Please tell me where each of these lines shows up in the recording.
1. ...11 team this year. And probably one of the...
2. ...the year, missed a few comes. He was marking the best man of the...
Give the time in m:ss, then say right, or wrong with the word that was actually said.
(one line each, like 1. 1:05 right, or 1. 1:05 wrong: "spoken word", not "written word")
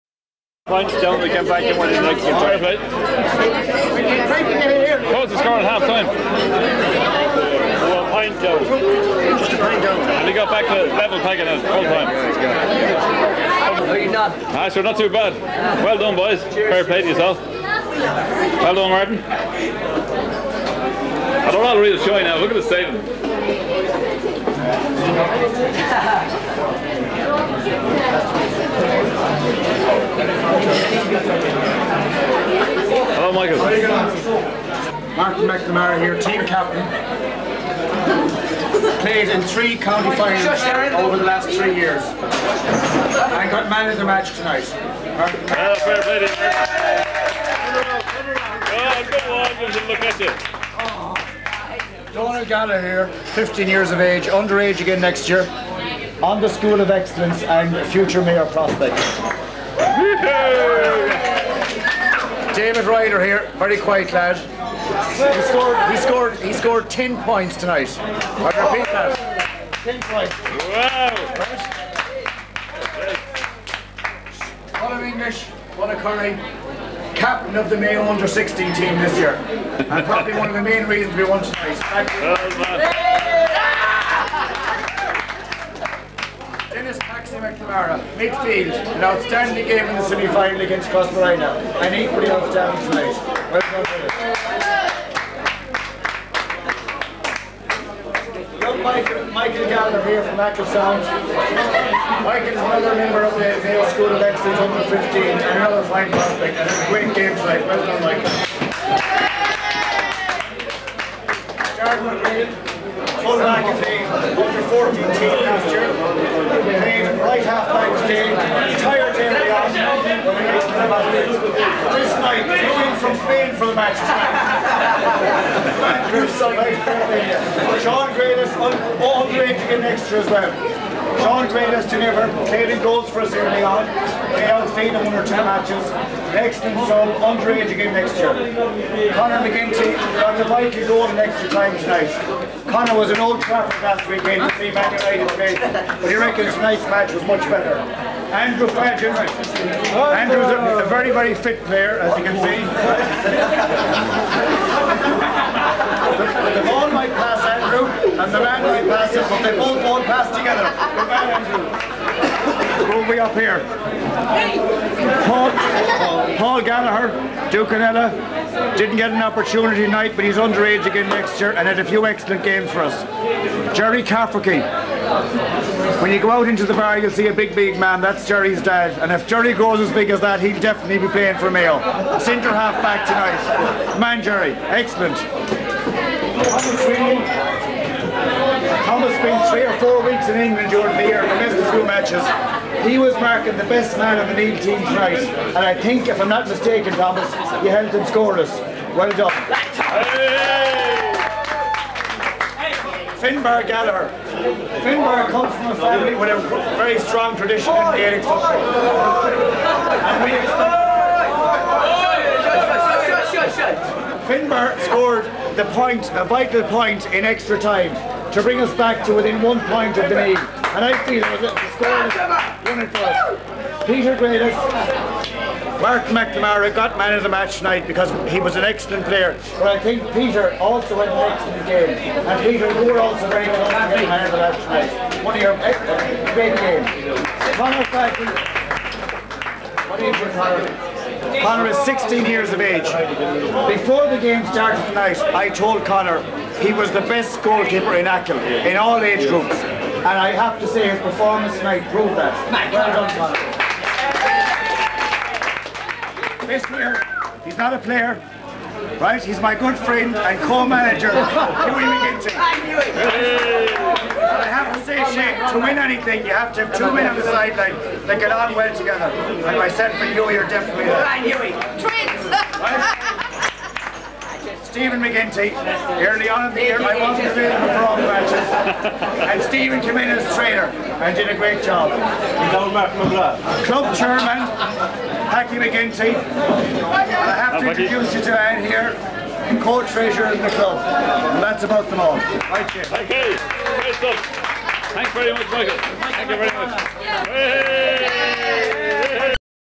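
1. 1:18 wrong: "16", not "11"
2. 3:10 wrong: "matches", not "comes".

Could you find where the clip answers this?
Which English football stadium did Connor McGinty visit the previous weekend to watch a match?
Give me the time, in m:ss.
2:23.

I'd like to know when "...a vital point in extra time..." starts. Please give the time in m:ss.
3:36.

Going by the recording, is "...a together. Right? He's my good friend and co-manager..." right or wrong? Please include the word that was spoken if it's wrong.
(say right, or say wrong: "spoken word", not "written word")
wrong: "player", not "together".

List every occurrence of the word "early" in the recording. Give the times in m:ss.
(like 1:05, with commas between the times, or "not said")
2:13, 4:36.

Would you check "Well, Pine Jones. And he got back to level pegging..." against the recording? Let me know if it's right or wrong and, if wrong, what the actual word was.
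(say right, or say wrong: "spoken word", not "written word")
right.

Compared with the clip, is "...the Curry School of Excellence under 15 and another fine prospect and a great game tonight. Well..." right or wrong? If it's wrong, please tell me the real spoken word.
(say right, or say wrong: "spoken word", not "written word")
wrong: "Mayo", not "Curry".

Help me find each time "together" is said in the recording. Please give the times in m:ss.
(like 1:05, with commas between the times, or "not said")
2:40, 4:28.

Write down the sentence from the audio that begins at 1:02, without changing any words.
David Ryder here, very quiet lad he scored, he scored, he scored 10 points tonight.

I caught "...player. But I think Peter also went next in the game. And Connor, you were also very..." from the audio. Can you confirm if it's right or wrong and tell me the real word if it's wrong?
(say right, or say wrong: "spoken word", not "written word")
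wrong: "Peter", not "Connor".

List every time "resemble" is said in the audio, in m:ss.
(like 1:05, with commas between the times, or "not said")
not said.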